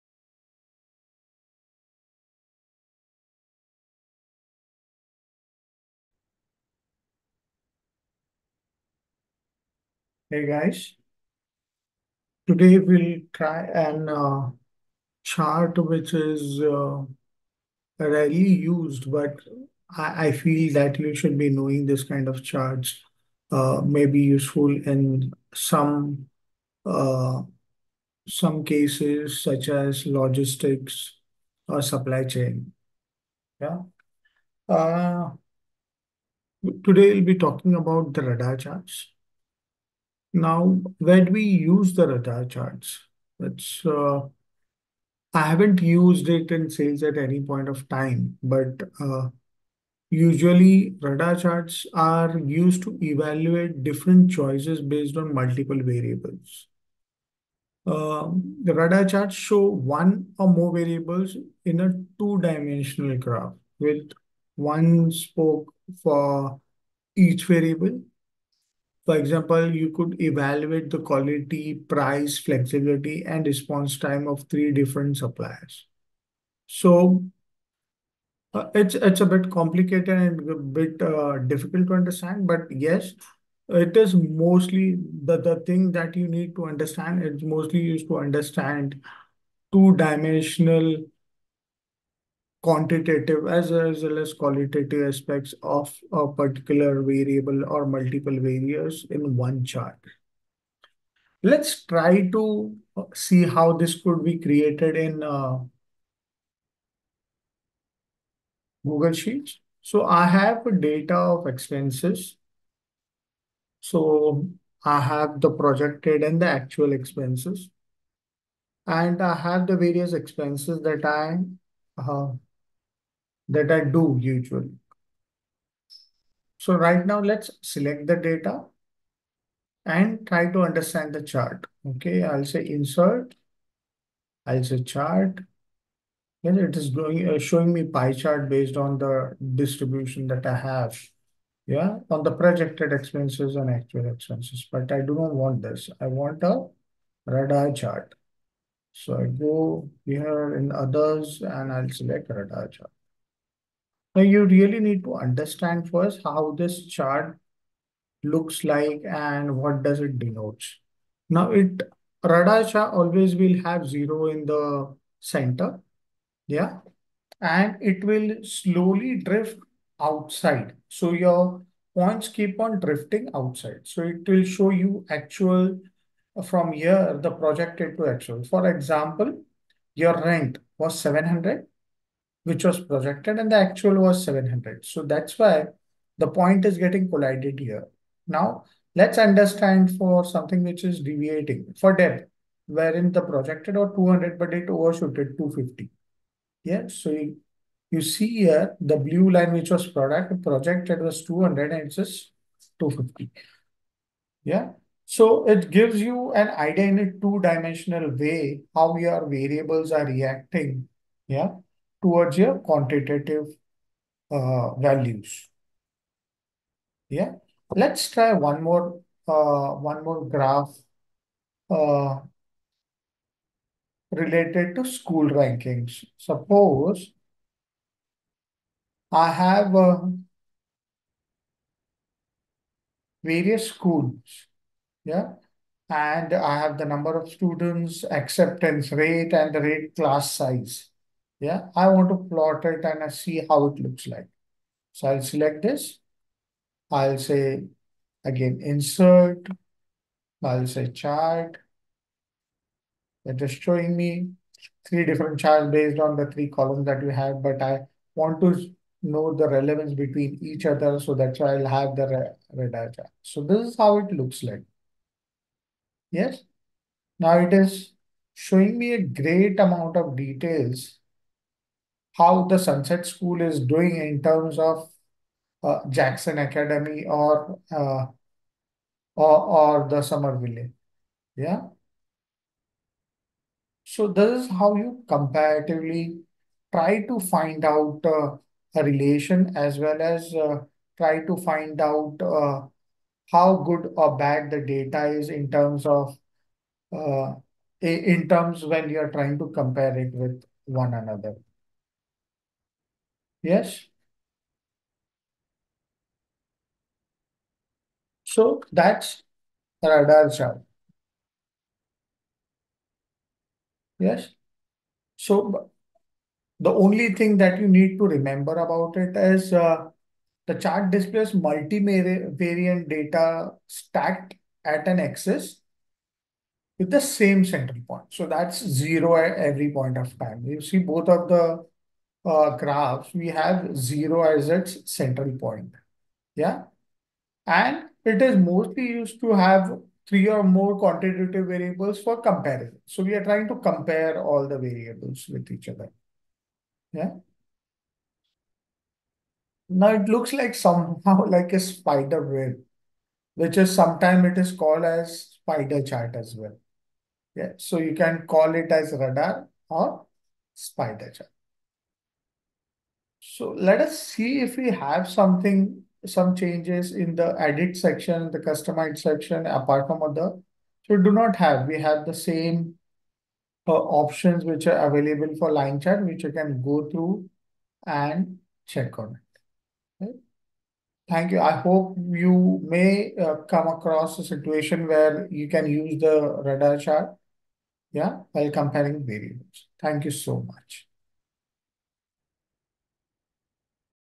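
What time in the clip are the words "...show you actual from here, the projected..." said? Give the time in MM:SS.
02:54.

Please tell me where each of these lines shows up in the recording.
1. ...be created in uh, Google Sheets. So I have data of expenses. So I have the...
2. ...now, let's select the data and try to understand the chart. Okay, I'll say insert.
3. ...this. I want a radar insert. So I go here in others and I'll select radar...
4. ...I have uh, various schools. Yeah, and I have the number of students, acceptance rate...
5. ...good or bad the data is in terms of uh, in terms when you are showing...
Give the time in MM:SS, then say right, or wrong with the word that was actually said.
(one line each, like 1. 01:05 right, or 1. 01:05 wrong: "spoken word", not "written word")
1. 01:44 right
2. 02:07 right
3. 02:25 wrong: "chart", not "insert"
4. 03:49 right
5. 04:53 wrong: "trying", not "showing".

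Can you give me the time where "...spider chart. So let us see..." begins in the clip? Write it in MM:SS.
06:00.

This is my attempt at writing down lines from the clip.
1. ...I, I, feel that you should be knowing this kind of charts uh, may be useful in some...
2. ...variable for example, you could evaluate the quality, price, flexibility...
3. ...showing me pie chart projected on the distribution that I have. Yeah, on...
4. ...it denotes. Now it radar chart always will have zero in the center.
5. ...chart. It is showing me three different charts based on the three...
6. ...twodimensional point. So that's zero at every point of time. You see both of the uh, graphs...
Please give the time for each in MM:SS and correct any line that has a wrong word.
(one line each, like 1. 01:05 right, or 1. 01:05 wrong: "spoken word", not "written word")
1. 00:19 right
2. 01:07 right
3. 02:17 wrong: "based", not "projected"
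4. 02:40 right
5. 04:10 right
6. 05:27 wrong: "central", not "twodimensional".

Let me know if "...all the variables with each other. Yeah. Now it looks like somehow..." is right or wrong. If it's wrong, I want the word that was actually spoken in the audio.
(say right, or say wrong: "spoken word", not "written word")
right.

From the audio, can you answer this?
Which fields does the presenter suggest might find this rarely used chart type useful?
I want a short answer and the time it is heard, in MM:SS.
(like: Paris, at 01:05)
logistics or supply chain, at 00:30.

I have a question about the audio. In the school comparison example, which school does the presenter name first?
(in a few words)
Sunset School.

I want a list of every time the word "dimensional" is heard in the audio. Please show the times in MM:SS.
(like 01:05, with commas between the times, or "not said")
01:02, 01:29, 03:27.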